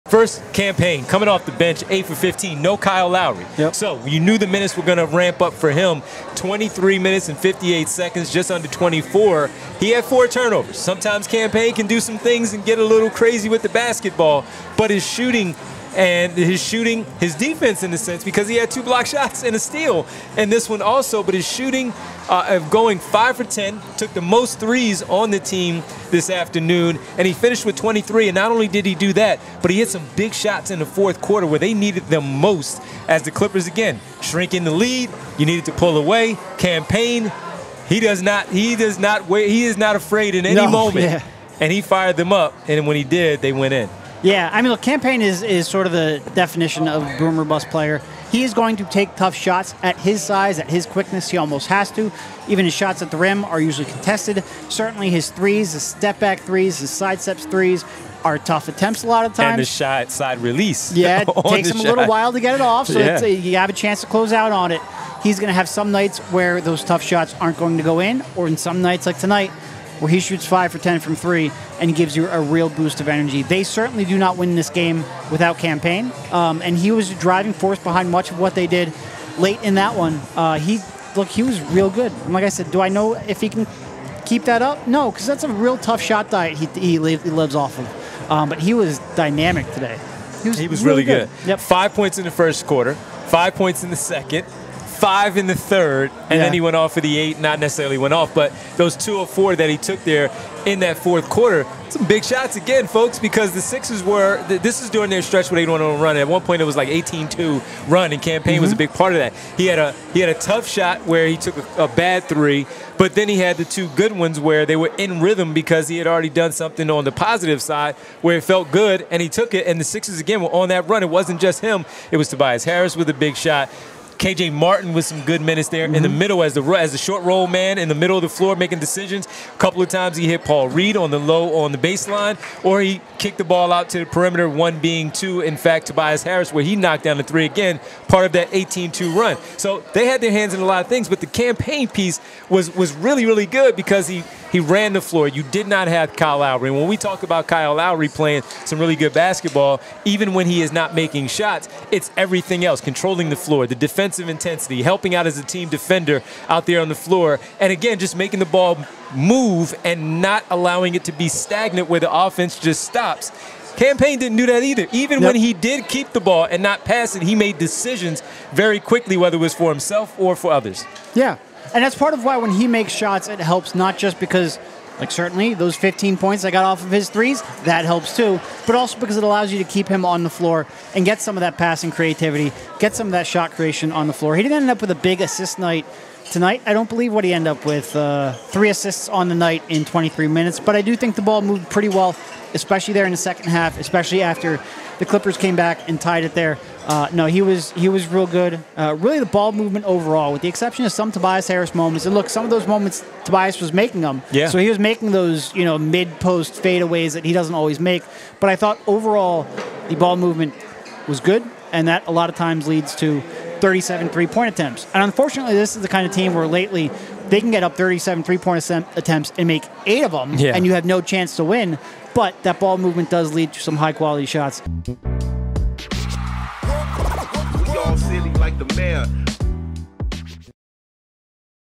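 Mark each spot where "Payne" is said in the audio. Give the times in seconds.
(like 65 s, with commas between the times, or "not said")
0 s, 11 s, 36 s, 44 s, 75 s, 108 s, 141 s, 163 s.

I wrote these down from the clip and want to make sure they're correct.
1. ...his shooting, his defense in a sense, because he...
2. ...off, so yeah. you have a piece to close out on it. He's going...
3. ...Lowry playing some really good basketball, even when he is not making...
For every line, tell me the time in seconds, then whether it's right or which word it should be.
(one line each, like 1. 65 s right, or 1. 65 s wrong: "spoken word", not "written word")
1. 16 s right
2. 62 s wrong: "chance", not "piece"
3. 147 s right.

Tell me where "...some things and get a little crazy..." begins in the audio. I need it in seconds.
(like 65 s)
12 s.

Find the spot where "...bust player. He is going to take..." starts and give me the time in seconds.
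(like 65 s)
47 s.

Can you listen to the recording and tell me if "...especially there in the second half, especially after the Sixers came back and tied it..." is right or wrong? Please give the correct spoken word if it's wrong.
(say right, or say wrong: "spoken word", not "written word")
wrong: "Clippers", not "Sixers".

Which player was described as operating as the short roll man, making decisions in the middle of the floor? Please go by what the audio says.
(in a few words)
KJ Martin.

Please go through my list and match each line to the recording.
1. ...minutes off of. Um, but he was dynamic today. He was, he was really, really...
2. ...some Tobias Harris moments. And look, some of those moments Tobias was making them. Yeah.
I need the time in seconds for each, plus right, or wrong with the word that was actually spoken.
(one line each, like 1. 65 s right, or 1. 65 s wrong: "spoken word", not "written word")
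1. 86 s wrong: "lives", not "minutes"
2. 200 s right.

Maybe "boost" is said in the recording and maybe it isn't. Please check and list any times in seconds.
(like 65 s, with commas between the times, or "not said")
72 s.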